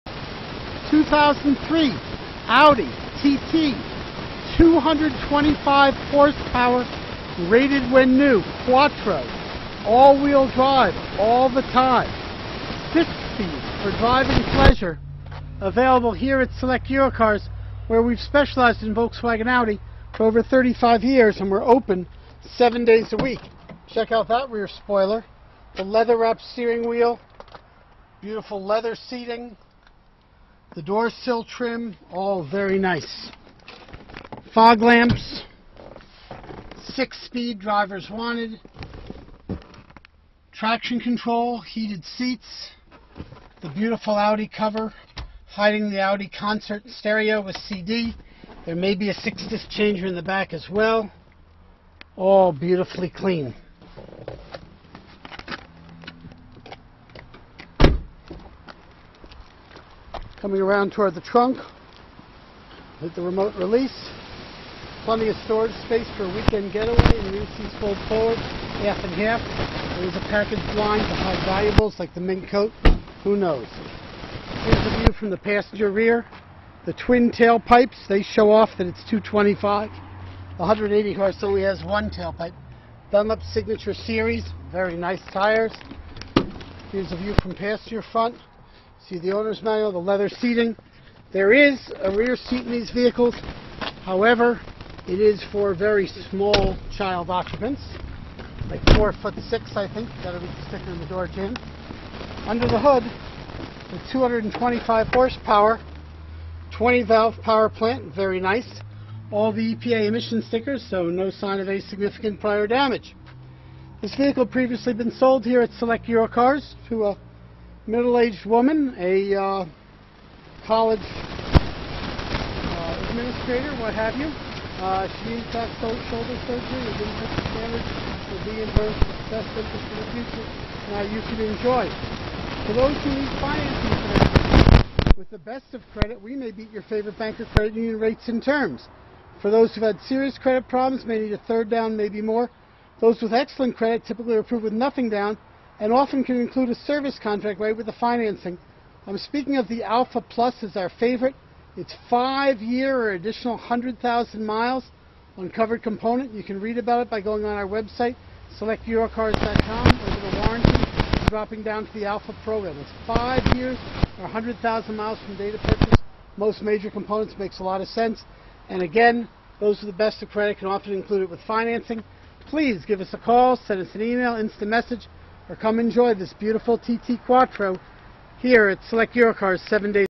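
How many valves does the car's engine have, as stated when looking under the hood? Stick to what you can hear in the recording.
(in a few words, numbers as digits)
20.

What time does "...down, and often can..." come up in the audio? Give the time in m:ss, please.
2:25.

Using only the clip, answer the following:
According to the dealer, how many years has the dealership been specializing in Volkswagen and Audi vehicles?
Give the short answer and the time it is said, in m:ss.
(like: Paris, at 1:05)
35, at 0:20.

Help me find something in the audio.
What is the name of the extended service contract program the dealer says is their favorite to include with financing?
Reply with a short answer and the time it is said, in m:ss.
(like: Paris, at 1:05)
Alpha Plus, at 2:29.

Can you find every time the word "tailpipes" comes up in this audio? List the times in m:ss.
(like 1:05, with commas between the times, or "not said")
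1:17, 1:22.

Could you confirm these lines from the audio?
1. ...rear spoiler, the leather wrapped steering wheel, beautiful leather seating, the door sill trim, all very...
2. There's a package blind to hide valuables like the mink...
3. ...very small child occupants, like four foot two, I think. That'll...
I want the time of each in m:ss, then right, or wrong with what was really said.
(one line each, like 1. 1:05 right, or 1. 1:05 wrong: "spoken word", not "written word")
1. 0:24 right
2. 1:10 right
3. 1:35 wrong: "six", not "two".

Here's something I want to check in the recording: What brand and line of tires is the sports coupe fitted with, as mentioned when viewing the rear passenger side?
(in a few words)
Dunlop Signature Series.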